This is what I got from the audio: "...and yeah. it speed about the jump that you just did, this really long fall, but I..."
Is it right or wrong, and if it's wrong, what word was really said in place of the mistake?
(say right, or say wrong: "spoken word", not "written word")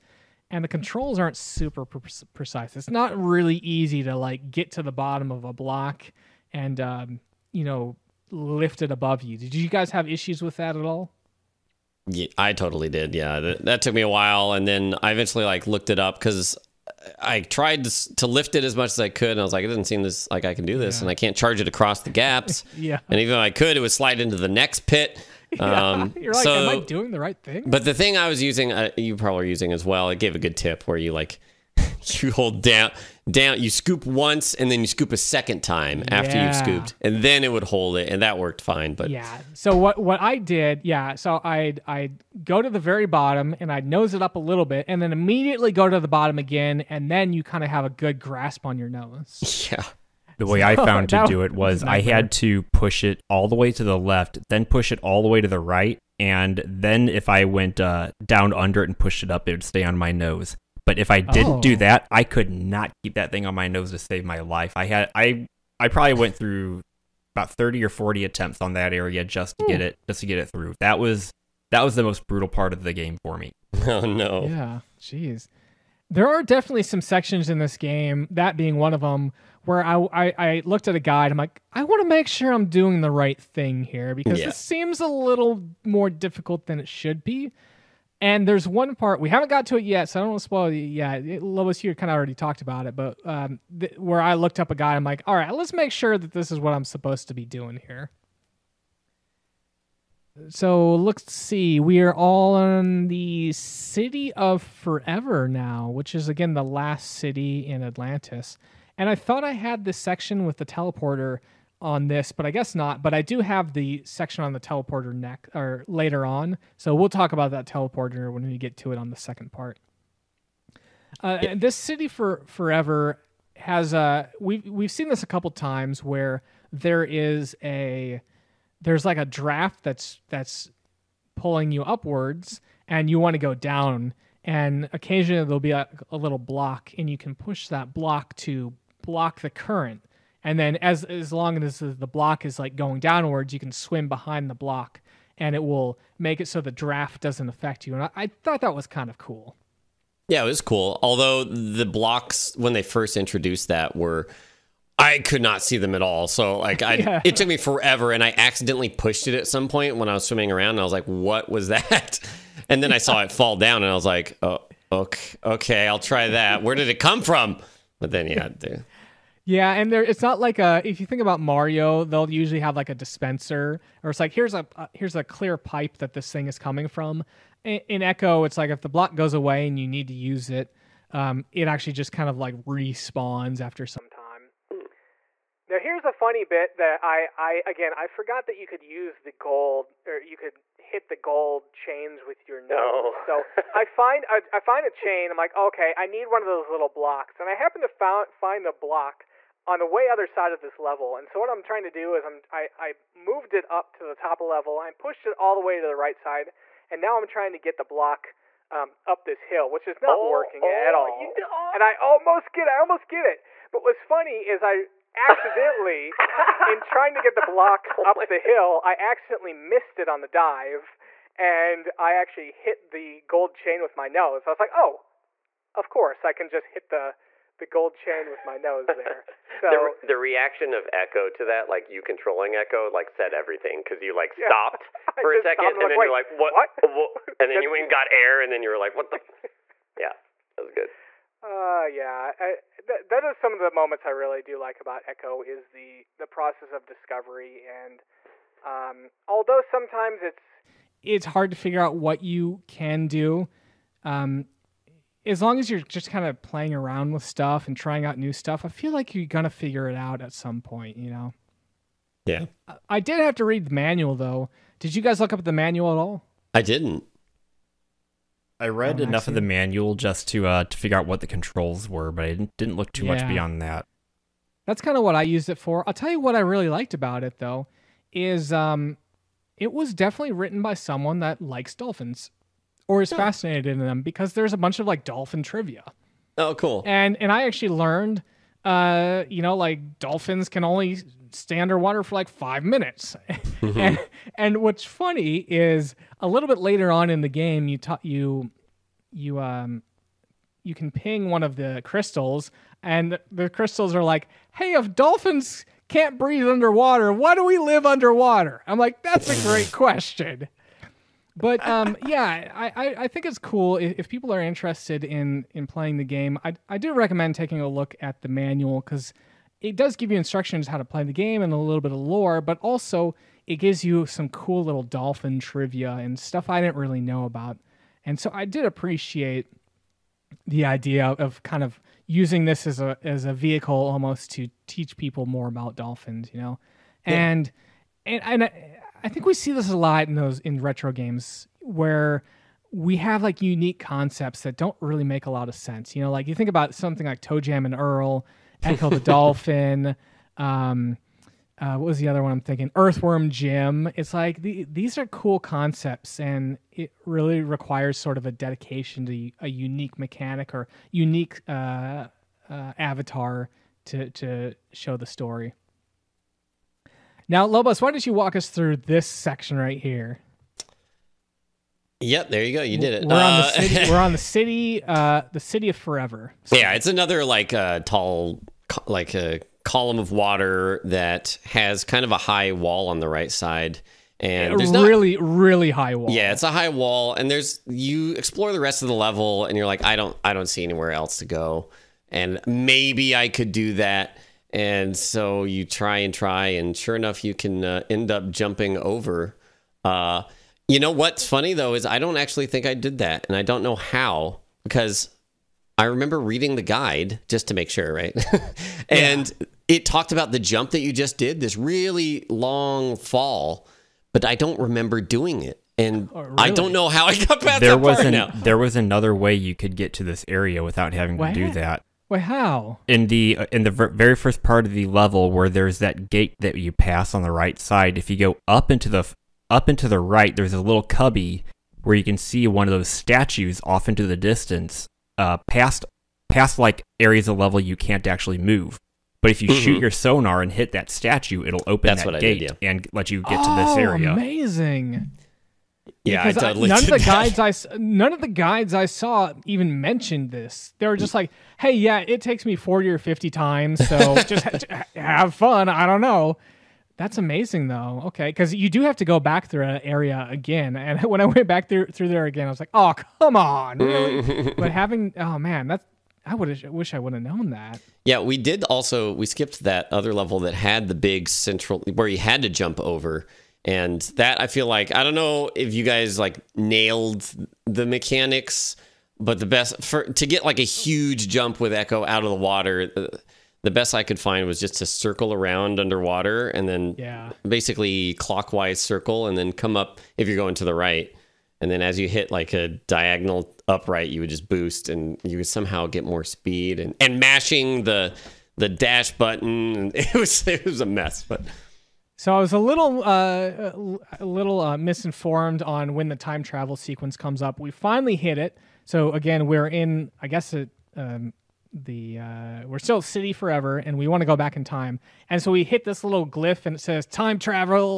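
wrong: "talked", not "speed".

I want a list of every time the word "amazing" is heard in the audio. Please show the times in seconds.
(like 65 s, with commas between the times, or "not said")
444 s, 457 s.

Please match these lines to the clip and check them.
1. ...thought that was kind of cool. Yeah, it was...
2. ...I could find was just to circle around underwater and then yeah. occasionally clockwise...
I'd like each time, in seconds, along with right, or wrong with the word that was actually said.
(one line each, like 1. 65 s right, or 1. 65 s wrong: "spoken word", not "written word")
1. 148 s right
2. 483 s wrong: "basically", not "occasionally".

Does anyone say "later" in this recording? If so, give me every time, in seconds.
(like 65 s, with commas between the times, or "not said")
115 s, 296 s.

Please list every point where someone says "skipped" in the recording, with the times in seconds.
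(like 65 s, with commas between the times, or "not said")
469 s.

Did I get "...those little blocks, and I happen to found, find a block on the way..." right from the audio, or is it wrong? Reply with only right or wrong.
right.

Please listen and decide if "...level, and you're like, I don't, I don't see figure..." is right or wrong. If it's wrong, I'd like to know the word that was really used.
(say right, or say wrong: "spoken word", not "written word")
wrong: "anywhere", not "figure".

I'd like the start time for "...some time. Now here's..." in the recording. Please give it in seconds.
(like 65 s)
183 s.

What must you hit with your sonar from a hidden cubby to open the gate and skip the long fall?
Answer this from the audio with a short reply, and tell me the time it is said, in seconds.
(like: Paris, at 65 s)
statue, at 440 s.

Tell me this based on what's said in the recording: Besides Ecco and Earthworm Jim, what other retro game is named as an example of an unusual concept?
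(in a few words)
ToeJam and Earl.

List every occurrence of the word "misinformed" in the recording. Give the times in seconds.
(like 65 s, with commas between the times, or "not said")
504 s.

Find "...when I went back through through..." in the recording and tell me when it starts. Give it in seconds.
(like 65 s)
461 s.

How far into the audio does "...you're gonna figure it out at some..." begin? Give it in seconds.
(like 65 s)
259 s.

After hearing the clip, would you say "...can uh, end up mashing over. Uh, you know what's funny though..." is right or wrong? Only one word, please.
wrong.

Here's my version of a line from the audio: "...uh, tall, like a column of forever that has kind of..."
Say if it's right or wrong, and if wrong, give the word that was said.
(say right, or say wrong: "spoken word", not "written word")
wrong: "water", not "forever".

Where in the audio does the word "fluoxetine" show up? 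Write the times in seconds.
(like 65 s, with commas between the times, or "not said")
not said.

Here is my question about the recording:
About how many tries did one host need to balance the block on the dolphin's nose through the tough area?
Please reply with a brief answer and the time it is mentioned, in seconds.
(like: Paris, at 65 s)
30 or 40, at 67 s.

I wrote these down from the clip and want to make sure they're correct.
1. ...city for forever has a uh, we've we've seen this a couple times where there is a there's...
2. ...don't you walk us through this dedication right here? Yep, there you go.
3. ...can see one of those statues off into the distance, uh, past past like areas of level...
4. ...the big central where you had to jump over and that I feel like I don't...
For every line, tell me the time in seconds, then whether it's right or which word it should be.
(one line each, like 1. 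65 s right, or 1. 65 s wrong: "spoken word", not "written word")
1. 121 s right
2. 367 s wrong: "section", not "dedication"
3. 432 s right
4. 470 s right.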